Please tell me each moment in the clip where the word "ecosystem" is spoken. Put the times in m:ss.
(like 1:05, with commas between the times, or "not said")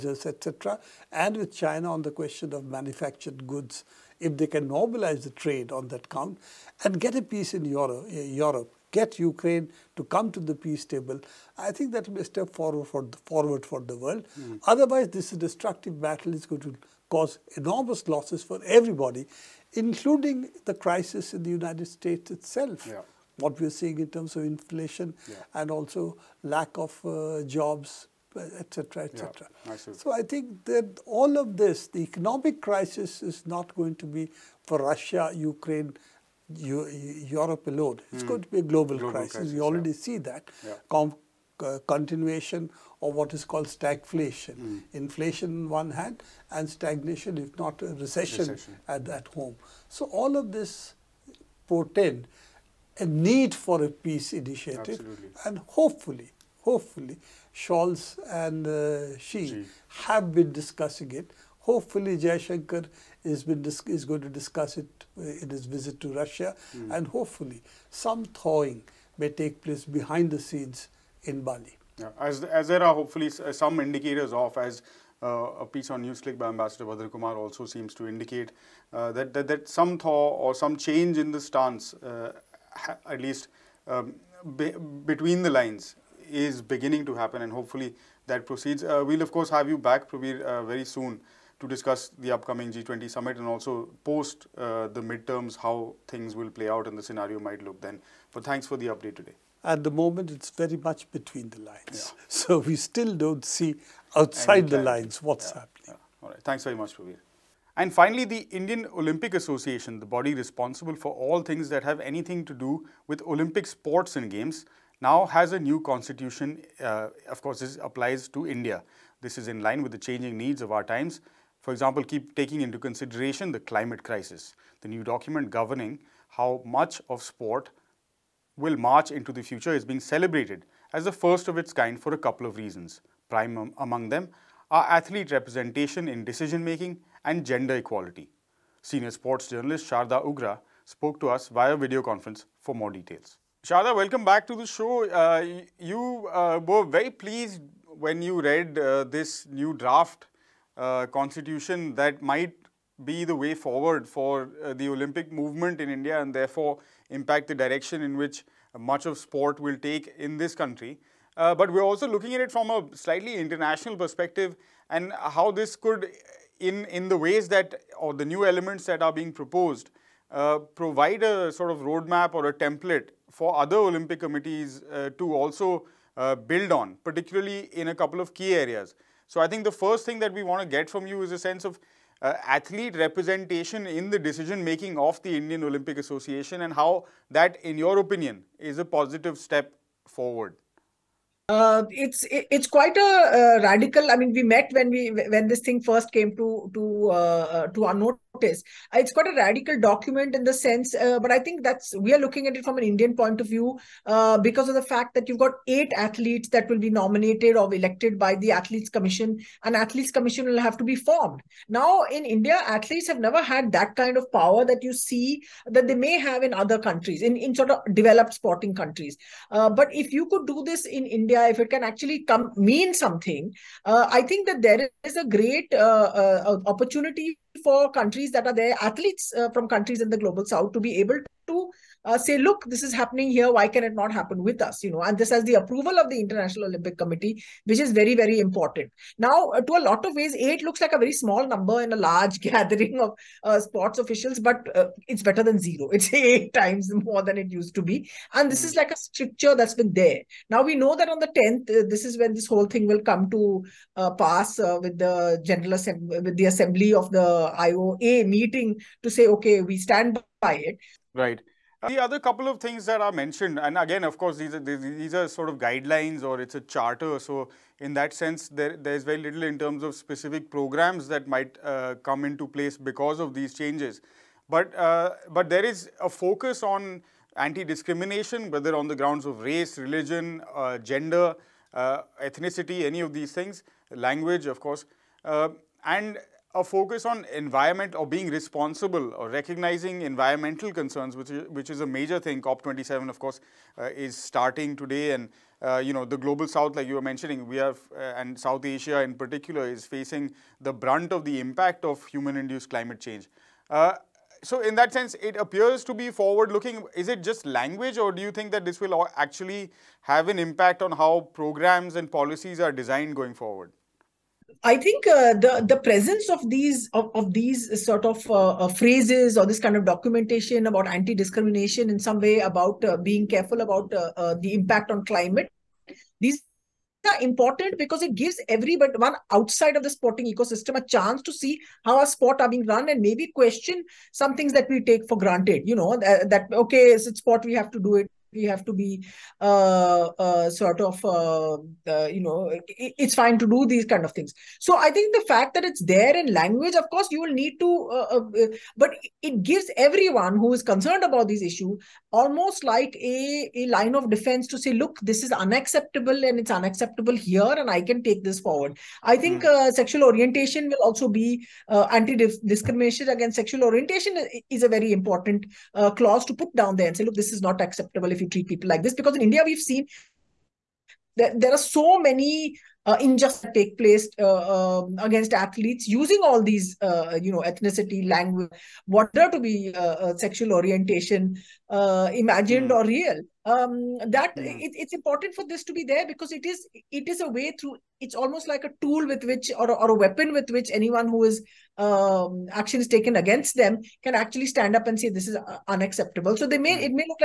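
5:30.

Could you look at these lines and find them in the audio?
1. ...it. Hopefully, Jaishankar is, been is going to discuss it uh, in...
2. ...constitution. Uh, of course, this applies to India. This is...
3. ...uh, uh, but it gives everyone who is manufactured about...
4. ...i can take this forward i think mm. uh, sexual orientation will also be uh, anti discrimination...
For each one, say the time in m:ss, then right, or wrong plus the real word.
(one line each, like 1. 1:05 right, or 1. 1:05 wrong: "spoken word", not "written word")
1. 1:01 right
2. 1:55 right
3. 5:47 wrong: "concerned", not "manufactured"
4. 5:57 right.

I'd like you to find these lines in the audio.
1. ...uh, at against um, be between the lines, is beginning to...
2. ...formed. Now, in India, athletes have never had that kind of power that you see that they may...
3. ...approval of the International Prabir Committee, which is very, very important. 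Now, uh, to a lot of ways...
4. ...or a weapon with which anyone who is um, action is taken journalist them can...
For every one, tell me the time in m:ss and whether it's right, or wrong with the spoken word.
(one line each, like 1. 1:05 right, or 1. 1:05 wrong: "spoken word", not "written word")
1. 1:21 wrong: "least", not "against"
2. 3:30 right
3. 3:55 wrong: "Olympic", not "Prabir"
4. 6:29 wrong: "against", not "journalist".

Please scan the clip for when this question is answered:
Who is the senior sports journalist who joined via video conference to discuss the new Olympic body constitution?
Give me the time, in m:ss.
2:19.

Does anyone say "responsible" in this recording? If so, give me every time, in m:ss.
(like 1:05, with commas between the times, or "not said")
1:50, 4:48.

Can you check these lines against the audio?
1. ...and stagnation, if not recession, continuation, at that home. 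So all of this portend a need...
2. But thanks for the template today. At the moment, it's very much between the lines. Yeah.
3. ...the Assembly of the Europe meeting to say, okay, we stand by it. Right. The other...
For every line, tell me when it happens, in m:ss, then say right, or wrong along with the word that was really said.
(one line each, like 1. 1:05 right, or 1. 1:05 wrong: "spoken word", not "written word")
1. 0:46 wrong: "recession", not "continuation"
2. 1:38 wrong: "update", not "template"
3. 4:16 wrong: "IOA", not "Europe".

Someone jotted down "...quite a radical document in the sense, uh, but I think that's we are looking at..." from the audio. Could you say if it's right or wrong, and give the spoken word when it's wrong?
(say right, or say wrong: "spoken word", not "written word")
right.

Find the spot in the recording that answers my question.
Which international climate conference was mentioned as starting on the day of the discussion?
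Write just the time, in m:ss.
4:52.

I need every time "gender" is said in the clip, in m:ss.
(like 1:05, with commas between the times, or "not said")
2:17, 4:40.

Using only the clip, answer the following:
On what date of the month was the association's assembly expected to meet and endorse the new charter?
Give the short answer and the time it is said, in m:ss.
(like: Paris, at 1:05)
10th, at 4:11.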